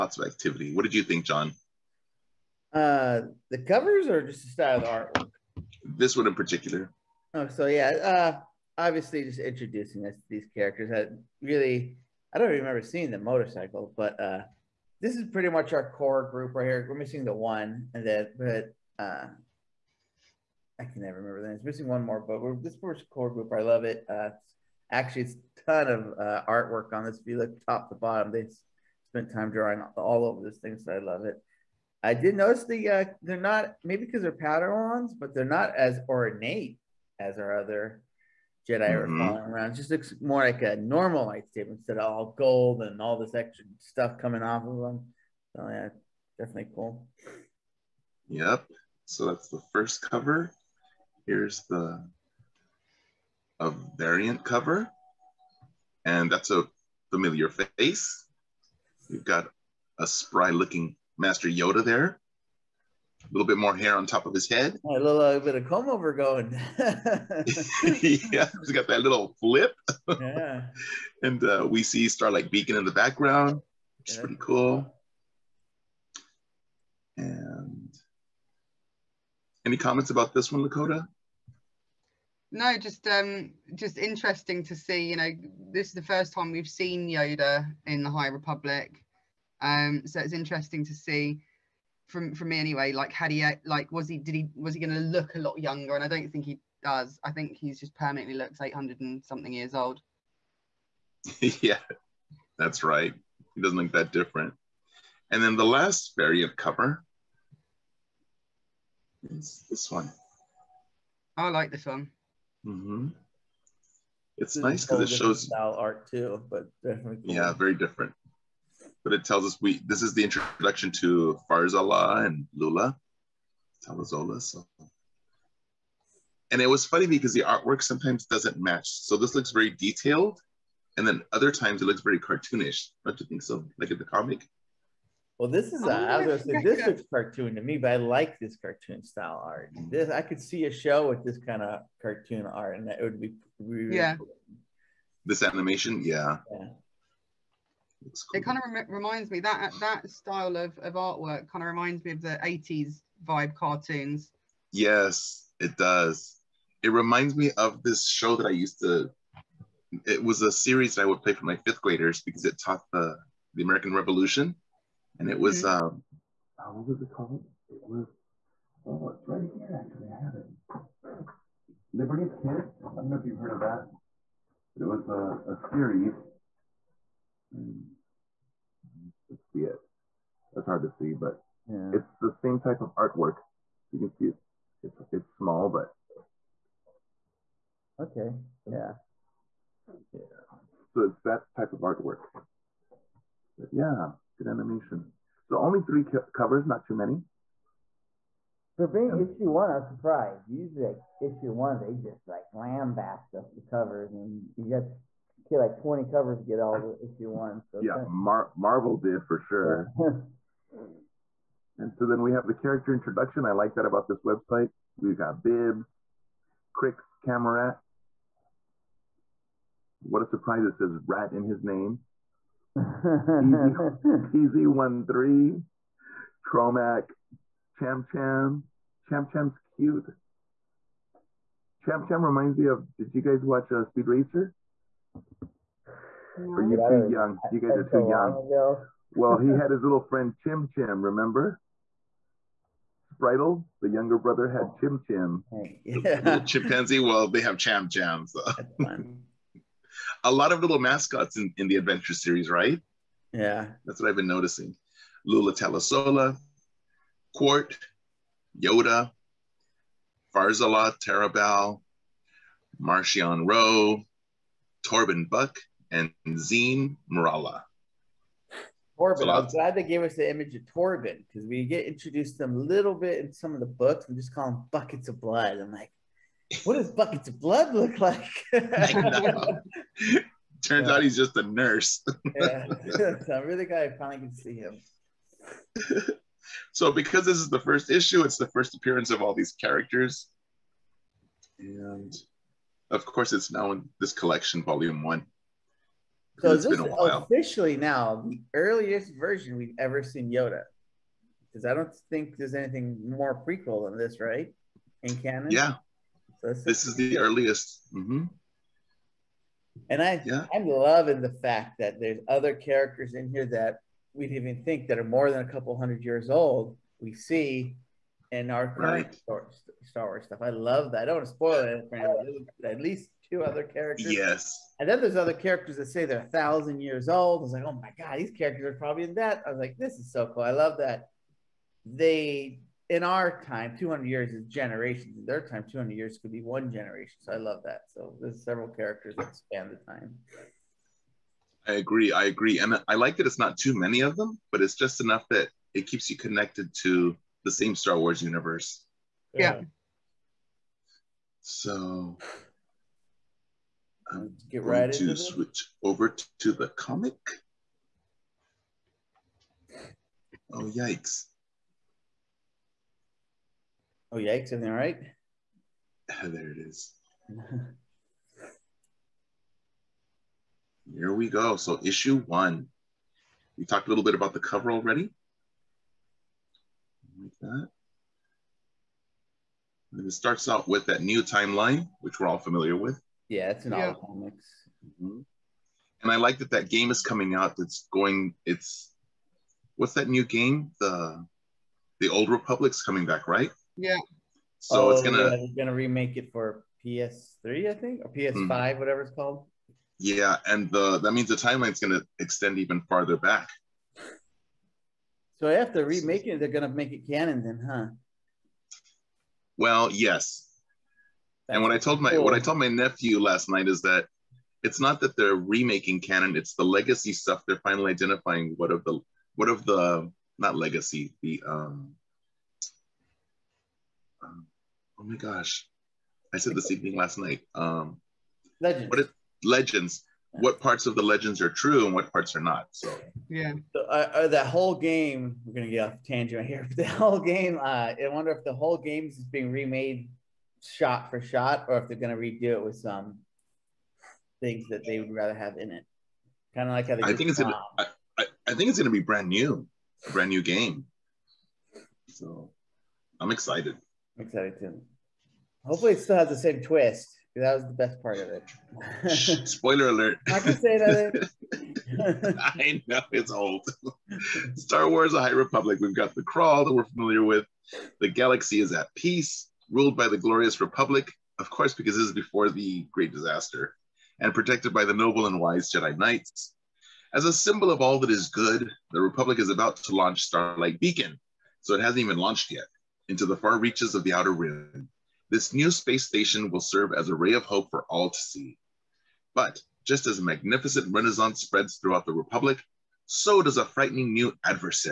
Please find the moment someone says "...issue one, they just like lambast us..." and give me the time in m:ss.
3:21.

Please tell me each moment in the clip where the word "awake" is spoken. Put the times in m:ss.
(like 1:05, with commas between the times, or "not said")
not said.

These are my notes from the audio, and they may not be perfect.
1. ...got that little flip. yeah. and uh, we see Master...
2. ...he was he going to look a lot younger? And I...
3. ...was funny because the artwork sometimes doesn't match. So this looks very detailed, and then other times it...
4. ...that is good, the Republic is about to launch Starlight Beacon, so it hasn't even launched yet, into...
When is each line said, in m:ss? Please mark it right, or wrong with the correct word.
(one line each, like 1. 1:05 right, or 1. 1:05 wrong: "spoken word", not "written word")
1. 1:08 wrong: "Starlight", not "Master"
2. 1:34 right
3. 2:06 right
4. 7:57 right.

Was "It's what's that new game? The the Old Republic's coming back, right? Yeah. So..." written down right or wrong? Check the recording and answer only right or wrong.
right.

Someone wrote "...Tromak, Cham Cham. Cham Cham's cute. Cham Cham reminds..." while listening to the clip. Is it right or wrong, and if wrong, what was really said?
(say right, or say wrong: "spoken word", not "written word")
right.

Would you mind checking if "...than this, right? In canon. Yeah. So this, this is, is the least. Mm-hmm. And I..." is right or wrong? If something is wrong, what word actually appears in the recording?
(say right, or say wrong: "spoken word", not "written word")
wrong: "earliest", not "least".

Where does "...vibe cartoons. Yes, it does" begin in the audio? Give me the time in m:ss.
2:33.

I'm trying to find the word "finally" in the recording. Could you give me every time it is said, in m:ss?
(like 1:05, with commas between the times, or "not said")
4:43, 6:57.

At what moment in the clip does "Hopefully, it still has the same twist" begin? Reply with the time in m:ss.
7:35.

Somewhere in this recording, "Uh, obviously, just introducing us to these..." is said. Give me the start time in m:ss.
0:07.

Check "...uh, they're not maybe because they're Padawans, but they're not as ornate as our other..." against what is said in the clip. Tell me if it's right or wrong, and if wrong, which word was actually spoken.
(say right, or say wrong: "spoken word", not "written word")
right.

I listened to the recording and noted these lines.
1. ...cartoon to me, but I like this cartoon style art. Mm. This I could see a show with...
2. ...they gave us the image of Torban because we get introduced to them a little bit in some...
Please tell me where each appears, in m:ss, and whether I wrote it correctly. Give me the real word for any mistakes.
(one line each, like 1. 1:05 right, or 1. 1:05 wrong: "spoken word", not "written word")
1. 2:17 right
2. 4:29 right.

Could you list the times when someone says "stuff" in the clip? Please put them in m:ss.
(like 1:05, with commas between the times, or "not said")
0:43, 5:20, 6:57.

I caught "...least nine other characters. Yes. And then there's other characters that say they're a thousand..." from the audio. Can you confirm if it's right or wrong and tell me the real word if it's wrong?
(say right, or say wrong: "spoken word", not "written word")
wrong: "two", not "nine".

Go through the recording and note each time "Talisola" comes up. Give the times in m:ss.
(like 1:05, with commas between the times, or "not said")
2:03, 4:15.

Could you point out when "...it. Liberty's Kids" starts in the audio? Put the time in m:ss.
2:50.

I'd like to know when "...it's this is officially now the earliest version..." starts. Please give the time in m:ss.
4:56.